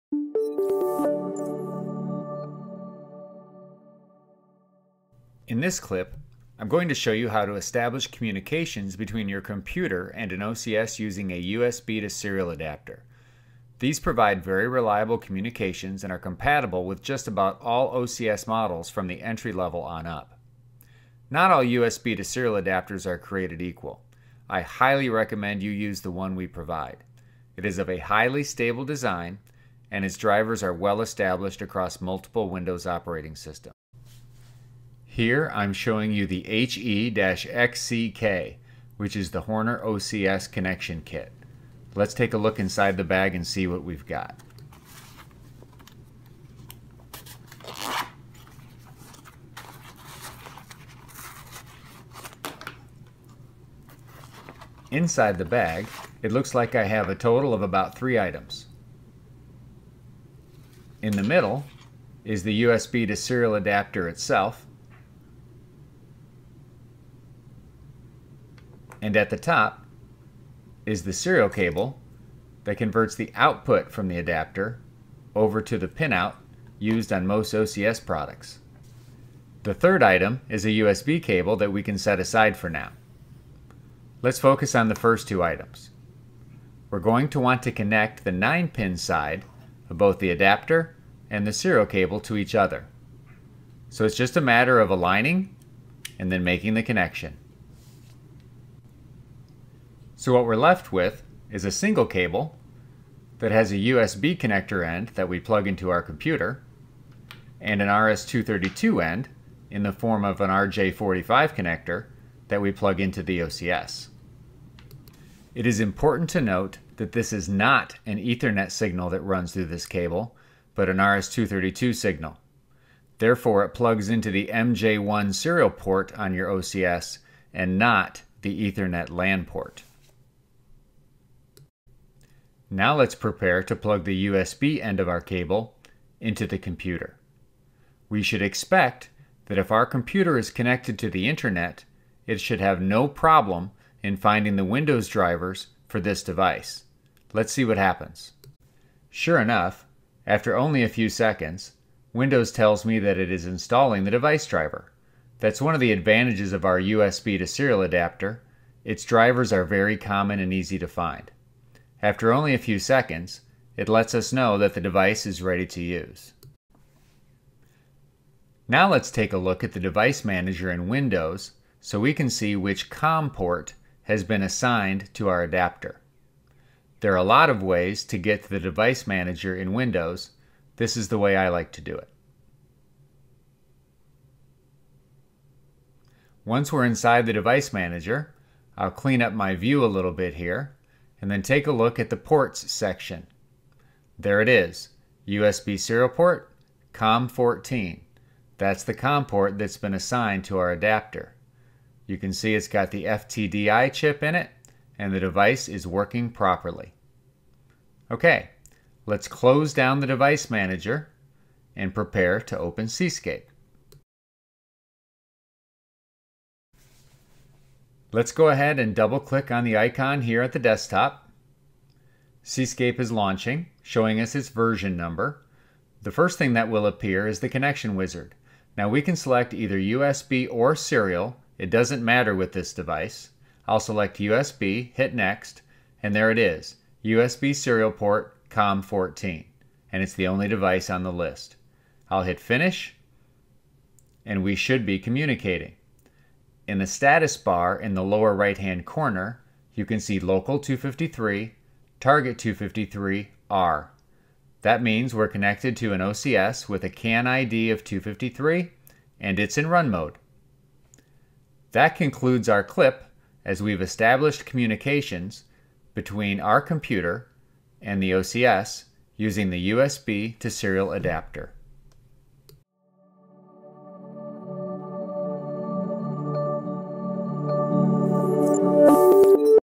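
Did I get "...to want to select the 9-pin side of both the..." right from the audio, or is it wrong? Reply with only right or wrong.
wrong.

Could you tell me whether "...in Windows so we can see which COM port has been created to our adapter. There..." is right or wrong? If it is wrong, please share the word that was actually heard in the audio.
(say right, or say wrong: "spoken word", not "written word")
wrong: "assigned", not "created".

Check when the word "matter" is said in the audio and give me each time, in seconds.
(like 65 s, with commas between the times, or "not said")
94 s, 232 s.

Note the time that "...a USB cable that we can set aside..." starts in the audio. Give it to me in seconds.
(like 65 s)
80 s.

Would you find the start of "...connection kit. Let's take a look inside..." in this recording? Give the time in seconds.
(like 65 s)
40 s.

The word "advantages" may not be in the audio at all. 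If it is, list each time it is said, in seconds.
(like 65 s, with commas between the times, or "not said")
155 s.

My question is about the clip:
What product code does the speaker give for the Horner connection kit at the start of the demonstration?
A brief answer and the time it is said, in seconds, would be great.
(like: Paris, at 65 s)
HE-XCK, at 36 s.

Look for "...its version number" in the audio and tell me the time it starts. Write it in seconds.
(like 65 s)
224 s.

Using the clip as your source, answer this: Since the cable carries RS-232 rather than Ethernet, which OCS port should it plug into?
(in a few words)
MJ1 serial port.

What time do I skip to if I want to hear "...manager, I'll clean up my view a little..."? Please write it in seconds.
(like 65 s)
187 s.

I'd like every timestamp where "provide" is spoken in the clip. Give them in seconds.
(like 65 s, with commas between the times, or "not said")
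13 s, 26 s.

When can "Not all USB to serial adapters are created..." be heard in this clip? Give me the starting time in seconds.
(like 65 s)
21 s.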